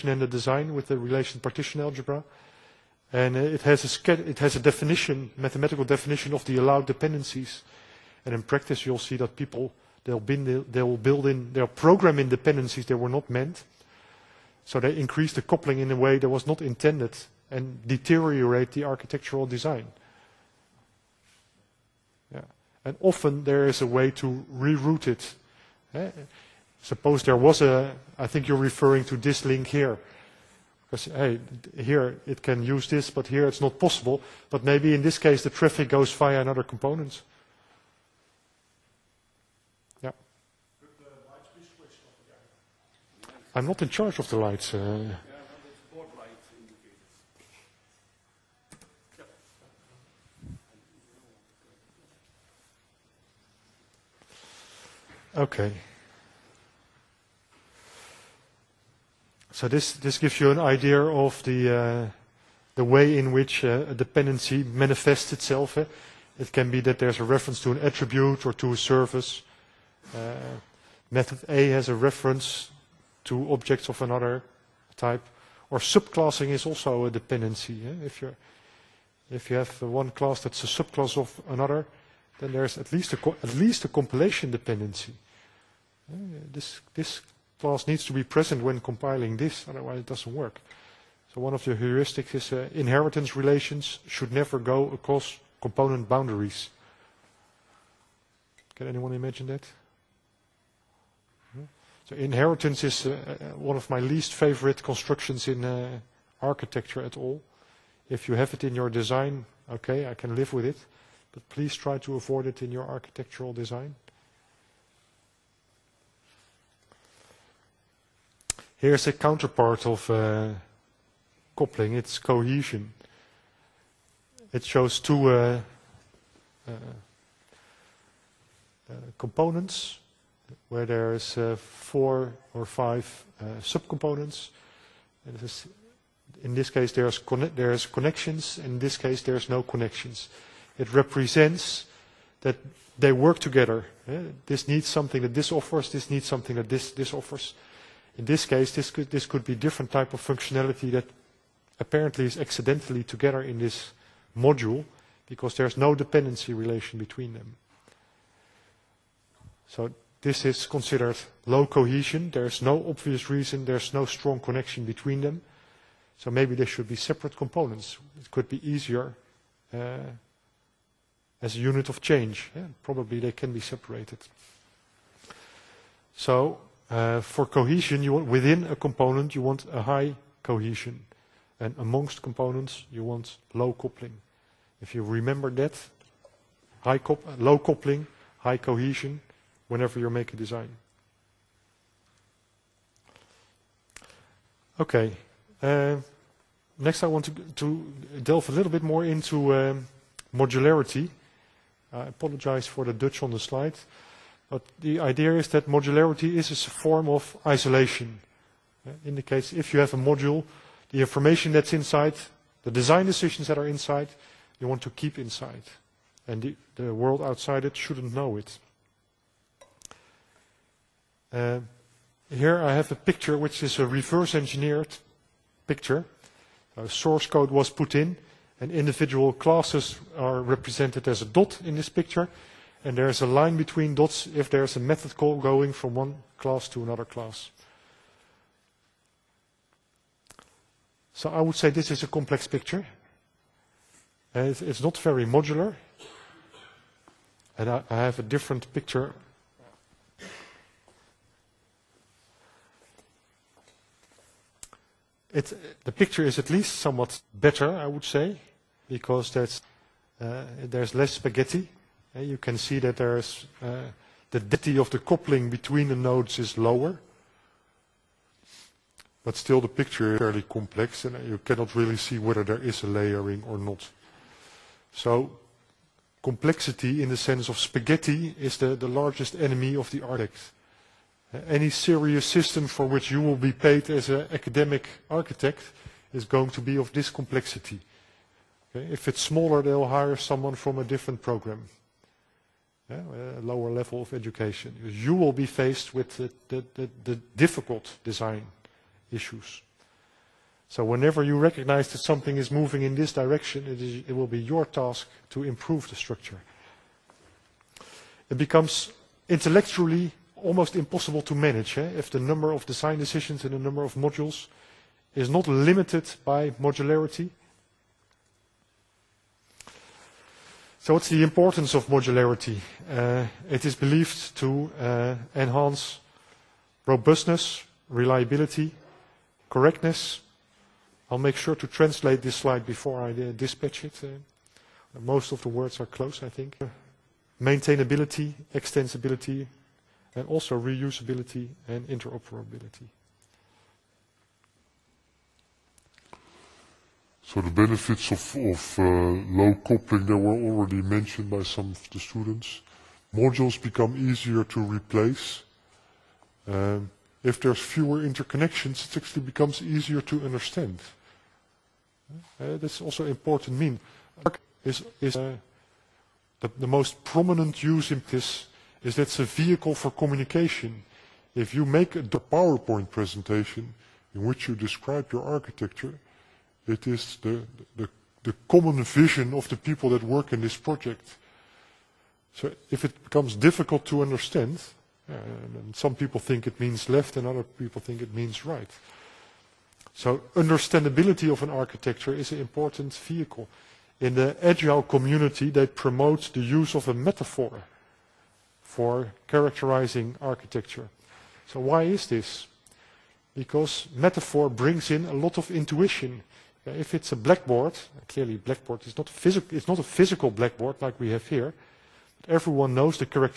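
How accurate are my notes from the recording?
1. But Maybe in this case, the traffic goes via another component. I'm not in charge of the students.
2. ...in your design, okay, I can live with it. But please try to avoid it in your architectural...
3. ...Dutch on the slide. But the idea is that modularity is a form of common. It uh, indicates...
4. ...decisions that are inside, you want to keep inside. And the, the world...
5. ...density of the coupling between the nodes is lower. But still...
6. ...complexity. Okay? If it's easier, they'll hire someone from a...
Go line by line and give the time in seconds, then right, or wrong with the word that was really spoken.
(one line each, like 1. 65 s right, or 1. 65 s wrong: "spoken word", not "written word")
1. 34 s wrong: "lights", not "students"
2. 108 s right
3. 202 s wrong: "isolation", not "common"
4. 213 s right
5. 264 s right
6. 287 s wrong: "smaller", not "easier".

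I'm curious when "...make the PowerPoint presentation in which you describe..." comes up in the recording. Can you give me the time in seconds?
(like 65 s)
371 s.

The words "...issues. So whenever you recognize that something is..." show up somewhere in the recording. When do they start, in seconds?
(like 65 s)
299 s.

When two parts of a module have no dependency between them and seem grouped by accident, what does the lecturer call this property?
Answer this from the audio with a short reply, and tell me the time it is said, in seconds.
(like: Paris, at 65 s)
low cohesion, at 161 s.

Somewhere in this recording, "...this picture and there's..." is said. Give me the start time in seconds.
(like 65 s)
231 s.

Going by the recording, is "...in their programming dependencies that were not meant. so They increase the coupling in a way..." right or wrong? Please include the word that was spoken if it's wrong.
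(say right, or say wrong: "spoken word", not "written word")
right.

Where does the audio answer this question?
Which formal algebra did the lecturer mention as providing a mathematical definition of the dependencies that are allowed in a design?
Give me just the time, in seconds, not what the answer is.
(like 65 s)
0 s.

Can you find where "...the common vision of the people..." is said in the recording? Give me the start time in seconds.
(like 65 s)
378 s.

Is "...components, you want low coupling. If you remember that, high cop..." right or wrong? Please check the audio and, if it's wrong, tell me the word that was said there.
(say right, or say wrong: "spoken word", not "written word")
right.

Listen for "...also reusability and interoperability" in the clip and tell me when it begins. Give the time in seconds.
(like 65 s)
340 s.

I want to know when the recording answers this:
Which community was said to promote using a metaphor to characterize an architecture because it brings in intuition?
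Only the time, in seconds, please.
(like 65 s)
394 s.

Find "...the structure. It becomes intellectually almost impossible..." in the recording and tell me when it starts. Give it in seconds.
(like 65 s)
305 s.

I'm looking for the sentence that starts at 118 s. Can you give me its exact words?
Here's a counterpart of uh, coupling.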